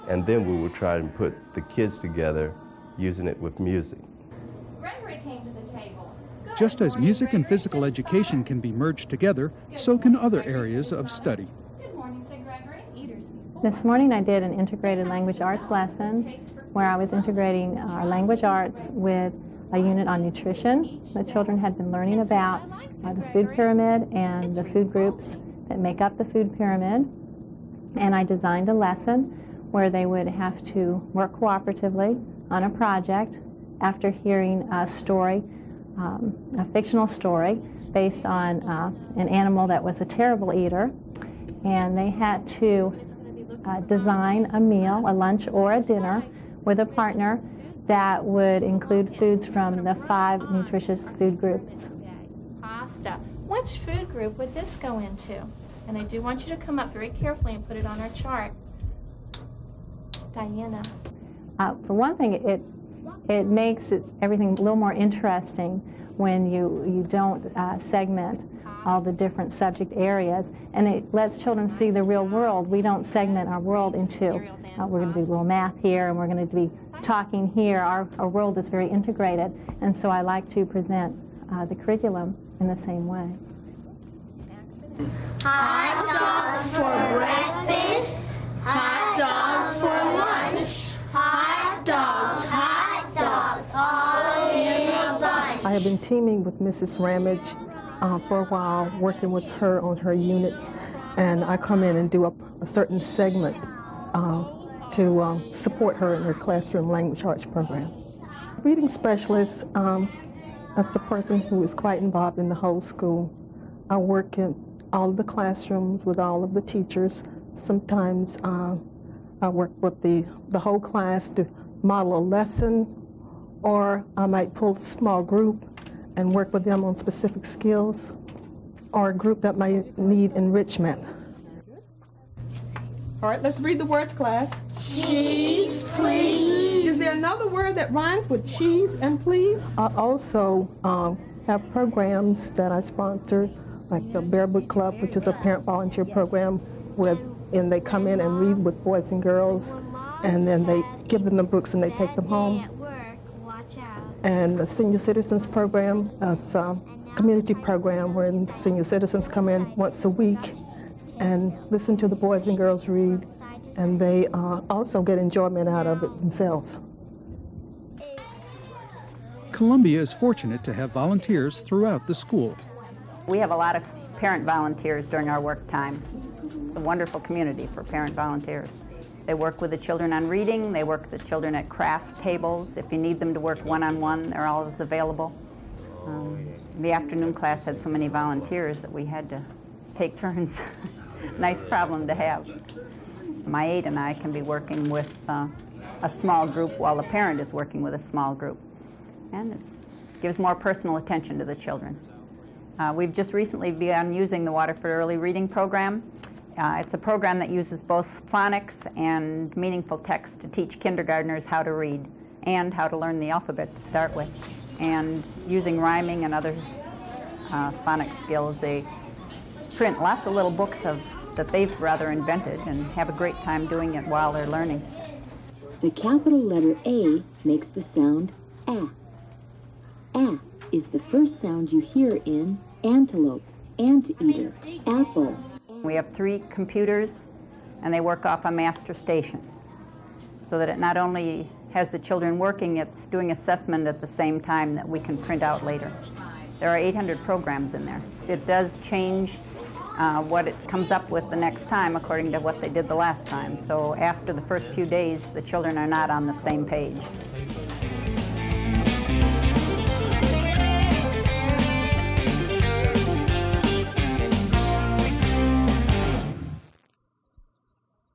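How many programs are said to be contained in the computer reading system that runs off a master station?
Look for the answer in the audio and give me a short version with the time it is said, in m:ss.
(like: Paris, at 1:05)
800, at 4:06.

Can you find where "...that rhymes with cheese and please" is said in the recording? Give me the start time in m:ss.
2:17.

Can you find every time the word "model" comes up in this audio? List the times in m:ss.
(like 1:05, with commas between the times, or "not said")
2:01.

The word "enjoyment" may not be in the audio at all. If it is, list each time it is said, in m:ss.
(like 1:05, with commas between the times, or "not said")
2:45.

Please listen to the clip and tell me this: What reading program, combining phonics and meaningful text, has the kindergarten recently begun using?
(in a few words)
Waterford Early Reading Program.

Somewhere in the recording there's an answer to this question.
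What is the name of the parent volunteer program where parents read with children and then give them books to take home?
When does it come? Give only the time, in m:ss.
2:24.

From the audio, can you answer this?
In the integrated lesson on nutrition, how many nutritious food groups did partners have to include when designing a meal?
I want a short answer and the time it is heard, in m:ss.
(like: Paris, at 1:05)
5, at 0:50.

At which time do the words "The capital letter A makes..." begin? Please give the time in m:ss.
3:45.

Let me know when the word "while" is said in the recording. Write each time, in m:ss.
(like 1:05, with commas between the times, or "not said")
1:38, 3:16, 3:44.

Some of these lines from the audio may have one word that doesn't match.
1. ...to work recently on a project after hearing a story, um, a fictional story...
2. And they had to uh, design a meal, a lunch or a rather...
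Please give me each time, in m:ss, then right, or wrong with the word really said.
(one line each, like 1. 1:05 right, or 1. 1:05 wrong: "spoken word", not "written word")
1. 0:30 wrong: "cooperatively", not "recently"
2. 0:41 wrong: "dinner", not "rather".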